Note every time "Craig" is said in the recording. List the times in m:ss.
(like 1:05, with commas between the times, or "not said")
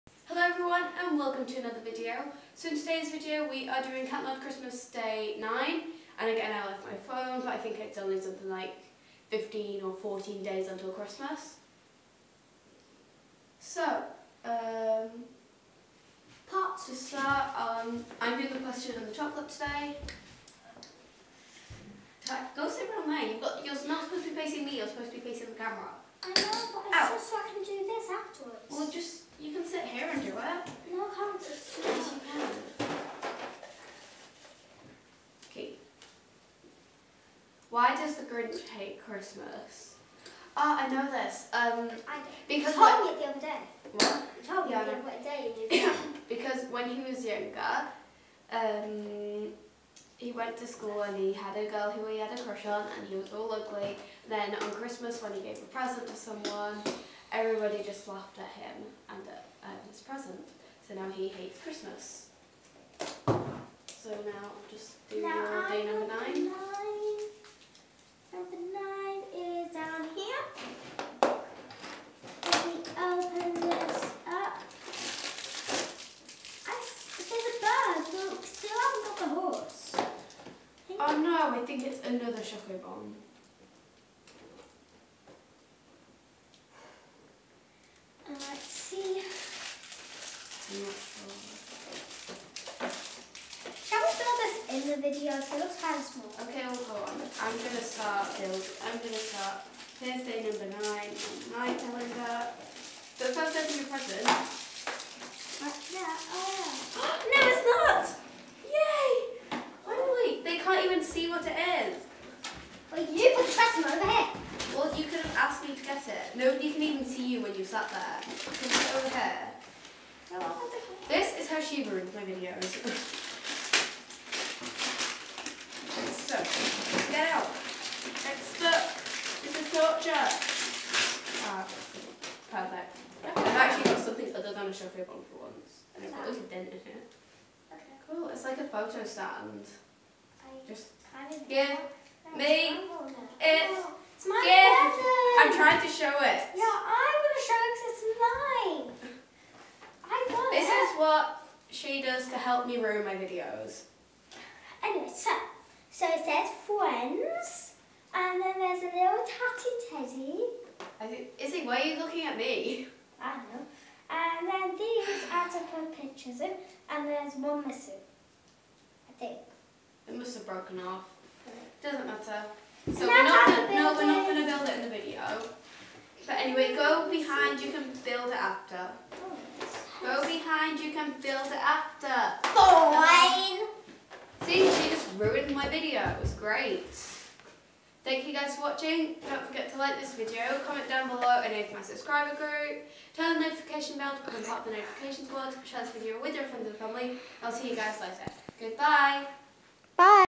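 not said.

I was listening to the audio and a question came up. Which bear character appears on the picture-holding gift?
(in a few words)
Tatty Teddy.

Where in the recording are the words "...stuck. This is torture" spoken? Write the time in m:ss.
2:08.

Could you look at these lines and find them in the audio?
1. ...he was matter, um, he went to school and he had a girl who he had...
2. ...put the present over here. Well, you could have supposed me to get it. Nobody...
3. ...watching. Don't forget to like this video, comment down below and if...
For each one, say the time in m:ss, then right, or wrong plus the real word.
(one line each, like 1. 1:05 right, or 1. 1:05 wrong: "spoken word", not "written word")
1. 0:46 wrong: "younger", not "matter"
2. 1:53 wrong: "asked", not "supposed"
3. 3:08 right.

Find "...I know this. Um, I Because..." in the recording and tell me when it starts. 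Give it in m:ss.
0:40.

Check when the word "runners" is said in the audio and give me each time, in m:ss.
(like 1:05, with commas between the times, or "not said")
not said.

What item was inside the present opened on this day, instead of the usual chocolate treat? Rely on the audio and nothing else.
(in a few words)
Photo stand.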